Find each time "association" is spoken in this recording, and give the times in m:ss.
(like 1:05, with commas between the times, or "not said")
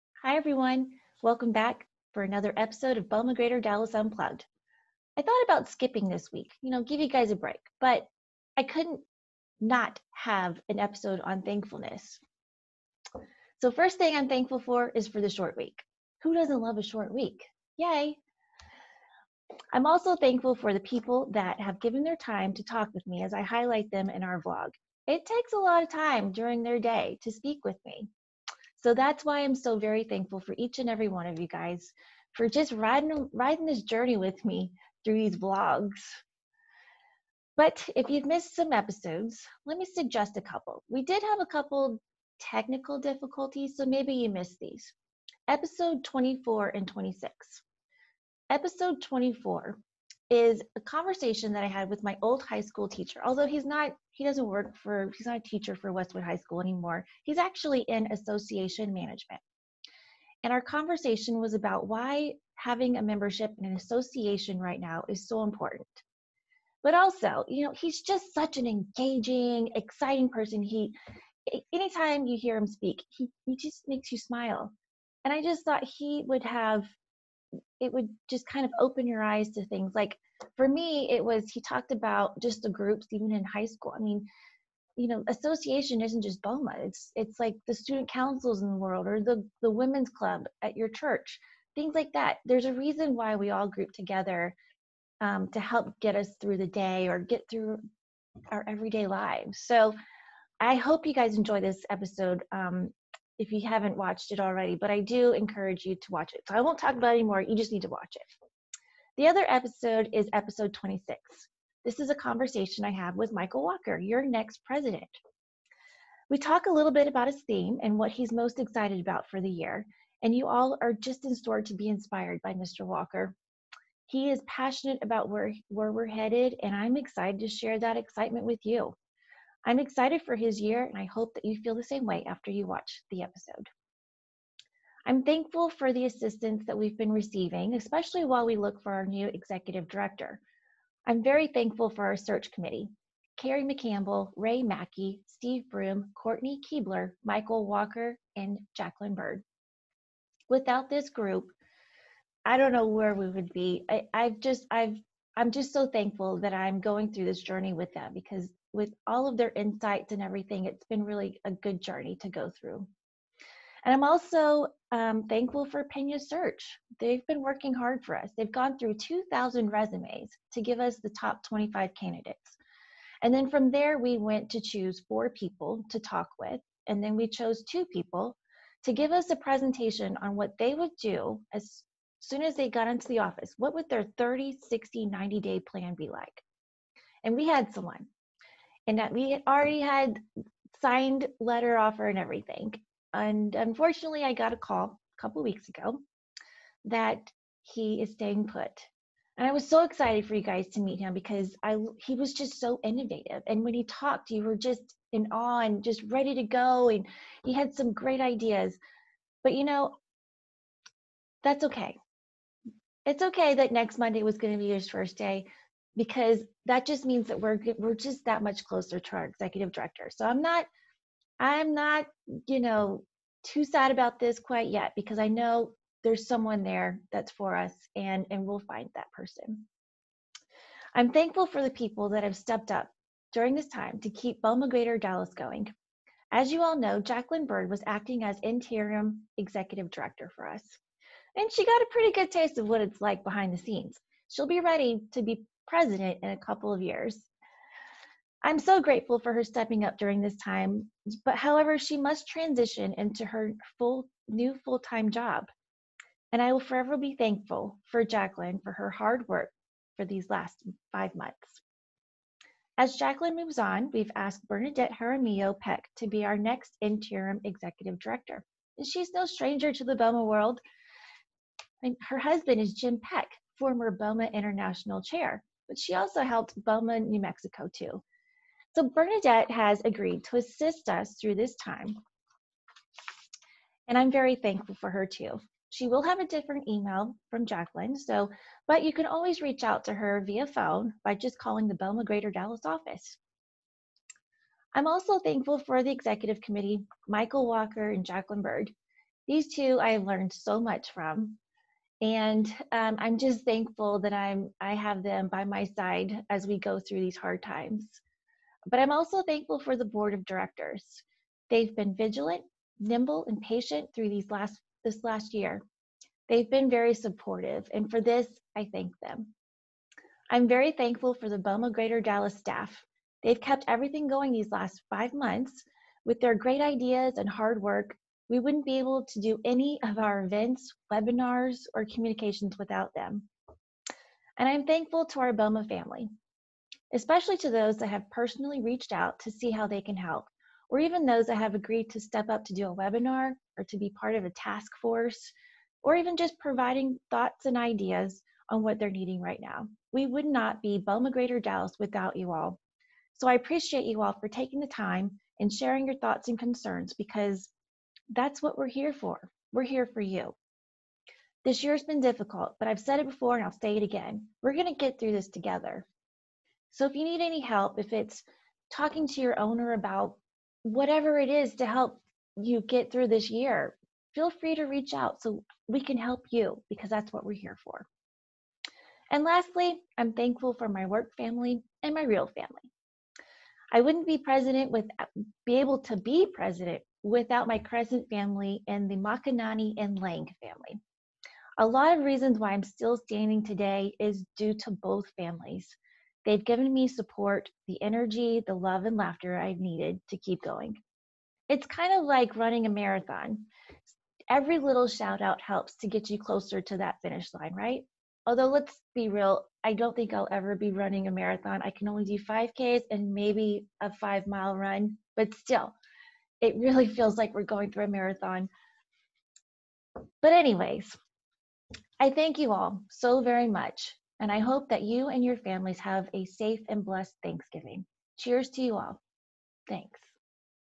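0:58, 1:03, 1:25.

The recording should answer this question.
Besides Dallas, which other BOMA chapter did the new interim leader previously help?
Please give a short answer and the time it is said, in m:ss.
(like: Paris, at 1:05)
New Mexico, at 4:36.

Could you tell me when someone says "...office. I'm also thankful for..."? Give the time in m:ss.
4:52.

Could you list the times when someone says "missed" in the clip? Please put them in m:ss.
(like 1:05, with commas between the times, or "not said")
0:38, 0:44.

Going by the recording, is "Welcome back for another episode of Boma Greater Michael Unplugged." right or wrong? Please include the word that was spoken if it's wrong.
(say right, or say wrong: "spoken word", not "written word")
wrong: "Dallas", not "Michael".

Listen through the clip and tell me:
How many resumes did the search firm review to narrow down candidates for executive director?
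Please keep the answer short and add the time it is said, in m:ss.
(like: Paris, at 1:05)
2,000, at 2:48.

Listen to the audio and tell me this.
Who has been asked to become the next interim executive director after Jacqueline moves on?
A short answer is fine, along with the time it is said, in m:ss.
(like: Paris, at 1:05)
Bernadette Jaramillo Peck, at 4:24.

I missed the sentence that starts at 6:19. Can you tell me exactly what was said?
And lastly, I'm thankful for my work family and my real family.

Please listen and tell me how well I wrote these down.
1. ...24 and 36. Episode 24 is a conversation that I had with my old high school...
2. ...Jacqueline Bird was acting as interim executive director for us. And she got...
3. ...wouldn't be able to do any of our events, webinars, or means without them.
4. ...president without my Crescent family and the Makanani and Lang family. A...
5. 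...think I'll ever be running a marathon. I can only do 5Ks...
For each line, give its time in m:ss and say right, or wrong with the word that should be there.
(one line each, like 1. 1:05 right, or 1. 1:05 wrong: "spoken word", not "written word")
1. 0:46 wrong: "26", not "36"
2. 3:57 right
3. 5:28 wrong: "communications", not "means"
4. 6:26 right
5. 6:49 right.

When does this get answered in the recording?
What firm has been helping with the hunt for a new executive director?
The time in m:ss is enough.
2:45.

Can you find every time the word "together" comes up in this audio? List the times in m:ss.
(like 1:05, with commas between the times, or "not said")
1:33, 6:05.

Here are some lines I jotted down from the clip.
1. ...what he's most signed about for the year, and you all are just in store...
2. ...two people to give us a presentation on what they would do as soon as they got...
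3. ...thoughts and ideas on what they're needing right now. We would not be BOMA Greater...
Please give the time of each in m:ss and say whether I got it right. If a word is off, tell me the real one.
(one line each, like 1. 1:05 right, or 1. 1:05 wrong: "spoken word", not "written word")
1. 1:57 wrong: "excited", not "signed"
2. 2:57 right
3. 5:47 right.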